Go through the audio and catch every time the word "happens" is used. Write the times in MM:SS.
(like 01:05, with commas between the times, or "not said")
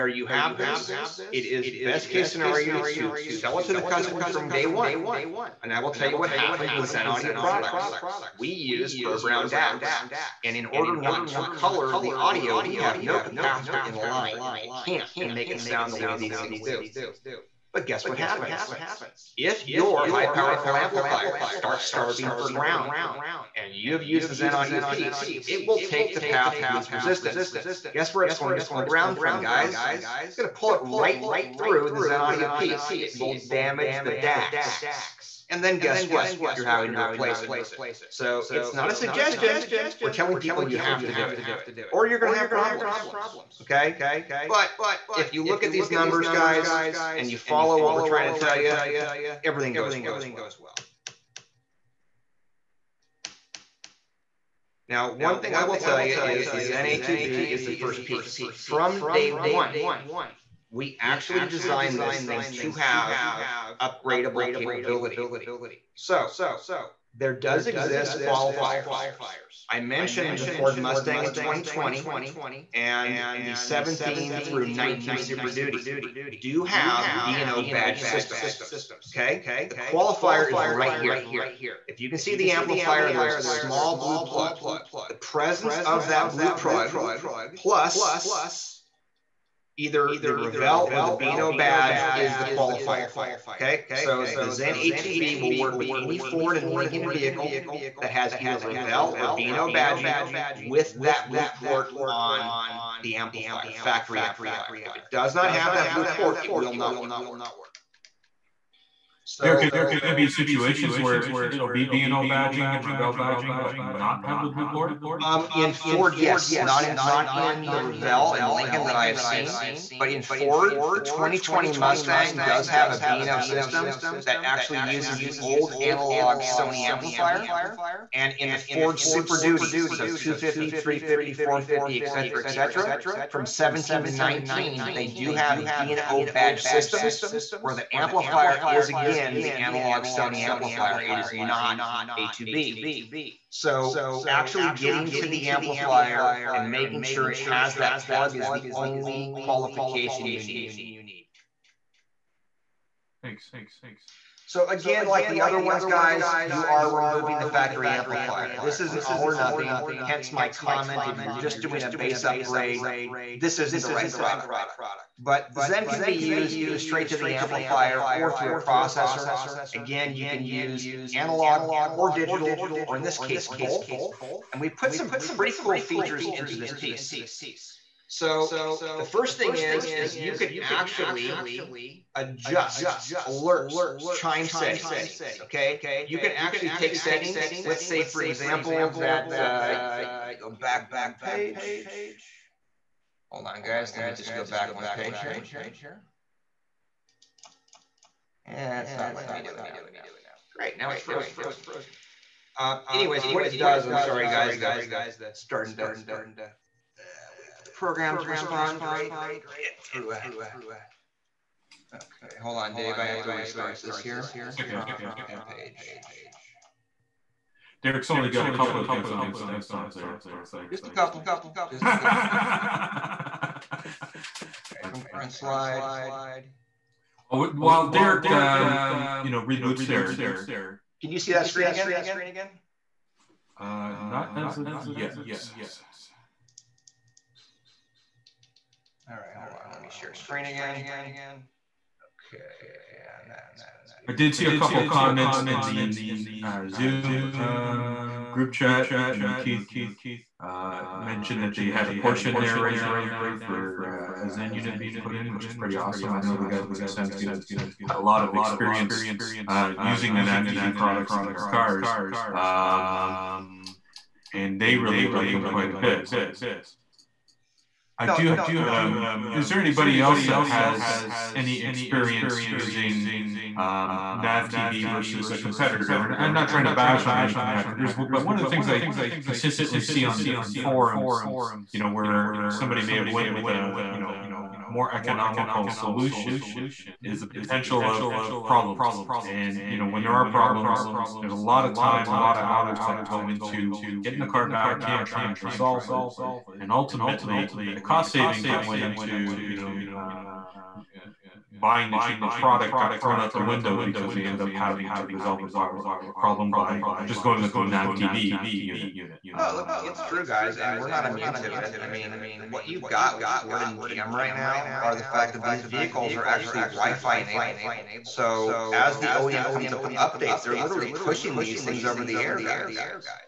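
00:06, 00:18.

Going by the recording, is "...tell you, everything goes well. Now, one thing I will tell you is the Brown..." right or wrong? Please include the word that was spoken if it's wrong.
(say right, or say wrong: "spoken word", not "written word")
wrong: "Zen", not "Brown".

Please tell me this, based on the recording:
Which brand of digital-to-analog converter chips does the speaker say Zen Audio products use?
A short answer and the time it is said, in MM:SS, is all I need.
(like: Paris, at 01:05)
Burr Brown, at 00:09.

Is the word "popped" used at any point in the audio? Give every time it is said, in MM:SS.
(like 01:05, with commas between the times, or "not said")
not said.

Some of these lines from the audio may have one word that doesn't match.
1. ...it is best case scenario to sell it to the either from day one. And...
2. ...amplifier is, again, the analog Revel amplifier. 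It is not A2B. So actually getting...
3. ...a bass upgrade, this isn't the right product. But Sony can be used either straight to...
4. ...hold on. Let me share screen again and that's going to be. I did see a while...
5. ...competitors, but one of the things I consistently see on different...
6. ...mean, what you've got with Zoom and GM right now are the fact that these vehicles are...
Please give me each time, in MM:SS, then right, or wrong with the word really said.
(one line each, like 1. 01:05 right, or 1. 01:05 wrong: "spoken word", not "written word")
1. 00:01 wrong: "customer", not "either"
2. 02:17 wrong: "Sony", not "Revel"
3. 02:41 wrong: "Zen", not "Sony"
4. 03:59 wrong: "couple", not "while"
5. 04:37 right
6. 05:11 wrong: "Ford", not "Zoom".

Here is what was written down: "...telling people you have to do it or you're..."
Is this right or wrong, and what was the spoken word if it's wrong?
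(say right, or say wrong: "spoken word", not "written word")
right.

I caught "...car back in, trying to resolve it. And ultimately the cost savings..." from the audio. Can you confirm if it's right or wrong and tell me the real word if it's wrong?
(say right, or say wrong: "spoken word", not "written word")
right.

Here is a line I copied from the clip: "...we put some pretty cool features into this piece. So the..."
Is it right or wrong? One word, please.
right.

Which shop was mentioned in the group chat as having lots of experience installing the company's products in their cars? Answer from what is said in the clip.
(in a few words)
Sounds Good.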